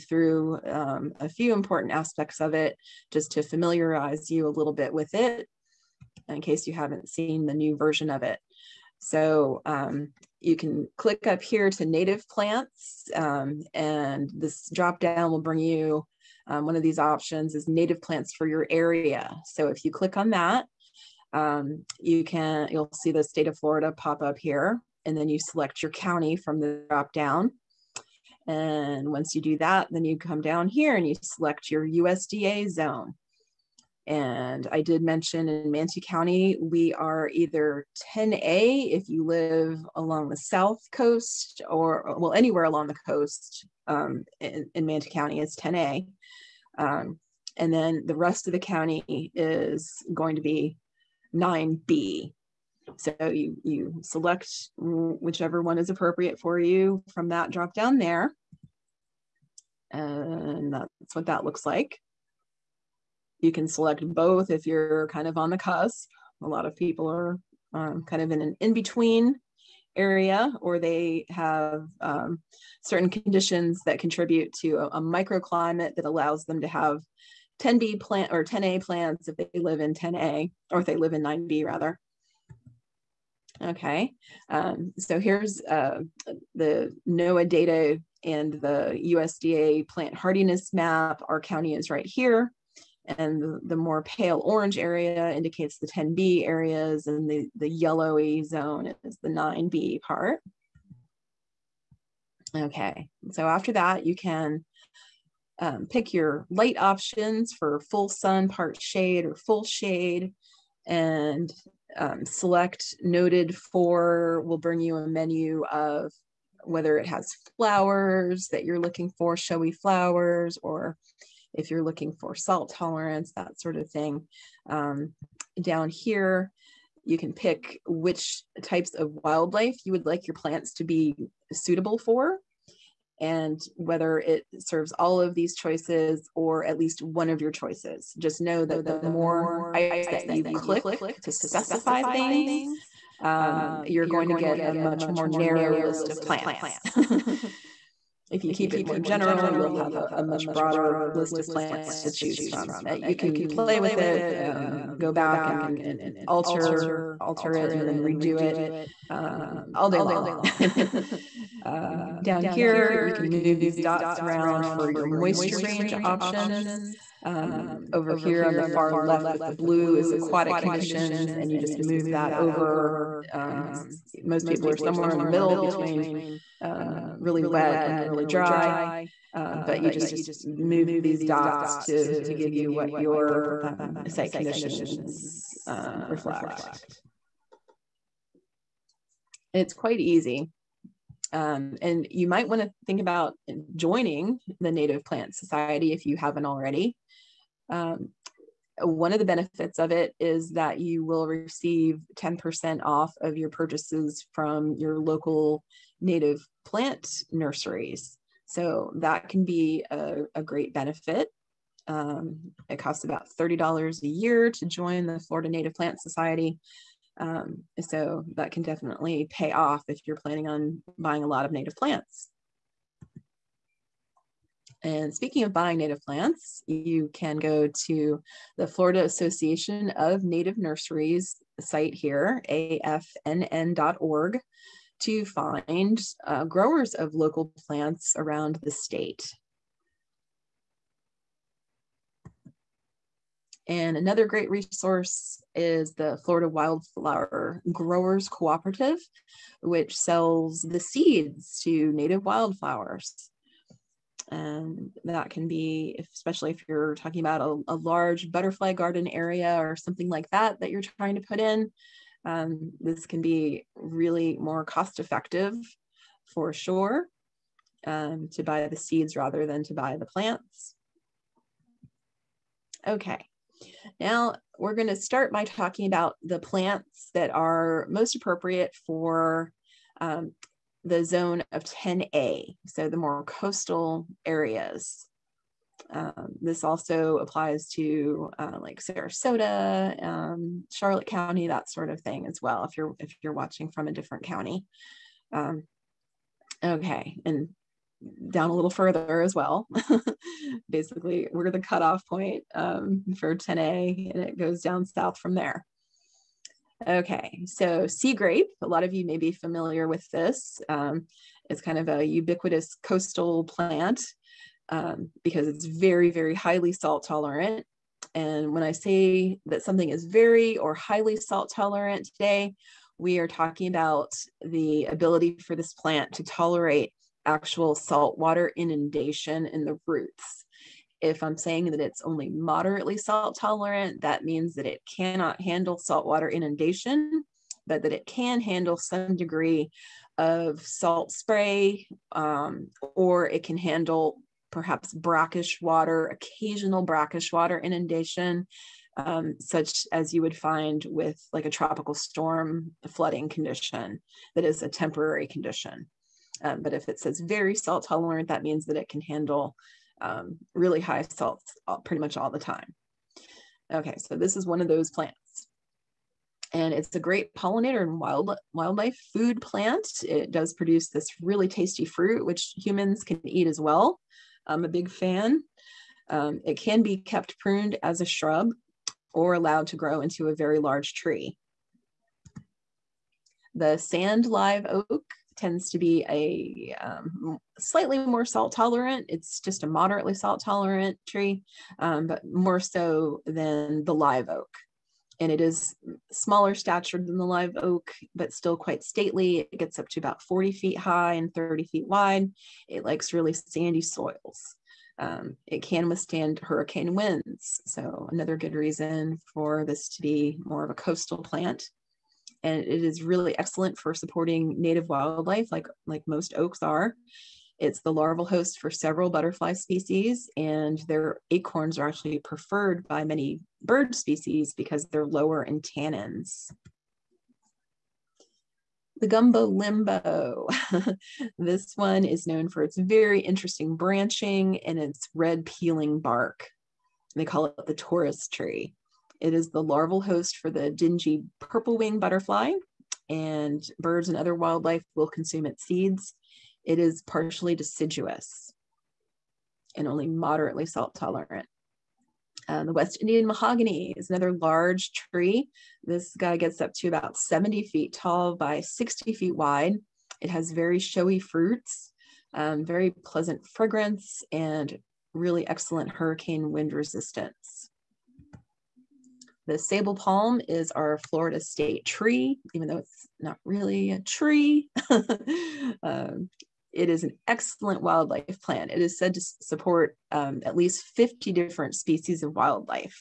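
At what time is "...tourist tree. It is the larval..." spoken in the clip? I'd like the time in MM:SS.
07:17.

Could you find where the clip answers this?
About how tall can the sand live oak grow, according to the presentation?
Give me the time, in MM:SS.
06:40.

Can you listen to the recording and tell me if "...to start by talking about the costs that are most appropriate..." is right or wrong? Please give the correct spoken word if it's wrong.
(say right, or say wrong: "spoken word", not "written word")
wrong: "plants", not "costs".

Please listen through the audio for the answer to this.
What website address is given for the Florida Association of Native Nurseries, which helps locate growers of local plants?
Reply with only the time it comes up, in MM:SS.
03:52.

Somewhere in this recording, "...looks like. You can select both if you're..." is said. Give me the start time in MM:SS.
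01:01.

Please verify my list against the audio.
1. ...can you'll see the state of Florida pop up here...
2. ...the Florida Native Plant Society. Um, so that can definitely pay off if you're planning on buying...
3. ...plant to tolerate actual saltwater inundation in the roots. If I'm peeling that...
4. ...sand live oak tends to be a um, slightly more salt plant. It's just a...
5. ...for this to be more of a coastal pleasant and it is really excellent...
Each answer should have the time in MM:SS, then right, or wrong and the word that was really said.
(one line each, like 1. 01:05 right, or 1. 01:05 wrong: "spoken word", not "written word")
1. 00:22 right
2. 03:35 right
3. 05:25 wrong: "saying", not "peeling"
4. 06:23 wrong: "tolerant", not "plant"
5. 06:49 wrong: "plant", not "pleasant".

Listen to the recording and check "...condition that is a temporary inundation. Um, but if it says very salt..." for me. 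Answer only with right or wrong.
wrong.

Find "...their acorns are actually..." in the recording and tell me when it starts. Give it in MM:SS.
07:00.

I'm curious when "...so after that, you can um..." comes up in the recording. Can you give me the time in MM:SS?
01:43.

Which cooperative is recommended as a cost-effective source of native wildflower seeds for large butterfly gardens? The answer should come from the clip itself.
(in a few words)
Florida Wildflower Growers Cooperative.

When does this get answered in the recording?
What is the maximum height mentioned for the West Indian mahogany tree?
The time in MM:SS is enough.
07:37.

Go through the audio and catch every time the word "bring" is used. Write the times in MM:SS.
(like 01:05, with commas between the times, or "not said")
00:15, 01:54.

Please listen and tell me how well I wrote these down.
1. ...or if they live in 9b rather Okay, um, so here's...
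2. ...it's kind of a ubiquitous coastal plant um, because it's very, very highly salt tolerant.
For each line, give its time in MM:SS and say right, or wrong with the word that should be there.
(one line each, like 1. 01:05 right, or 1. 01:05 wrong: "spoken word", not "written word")
1. 01:20 right
2. 05:11 right.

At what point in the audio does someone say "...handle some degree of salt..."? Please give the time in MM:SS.
05:38.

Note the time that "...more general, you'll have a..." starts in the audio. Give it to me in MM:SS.
02:28.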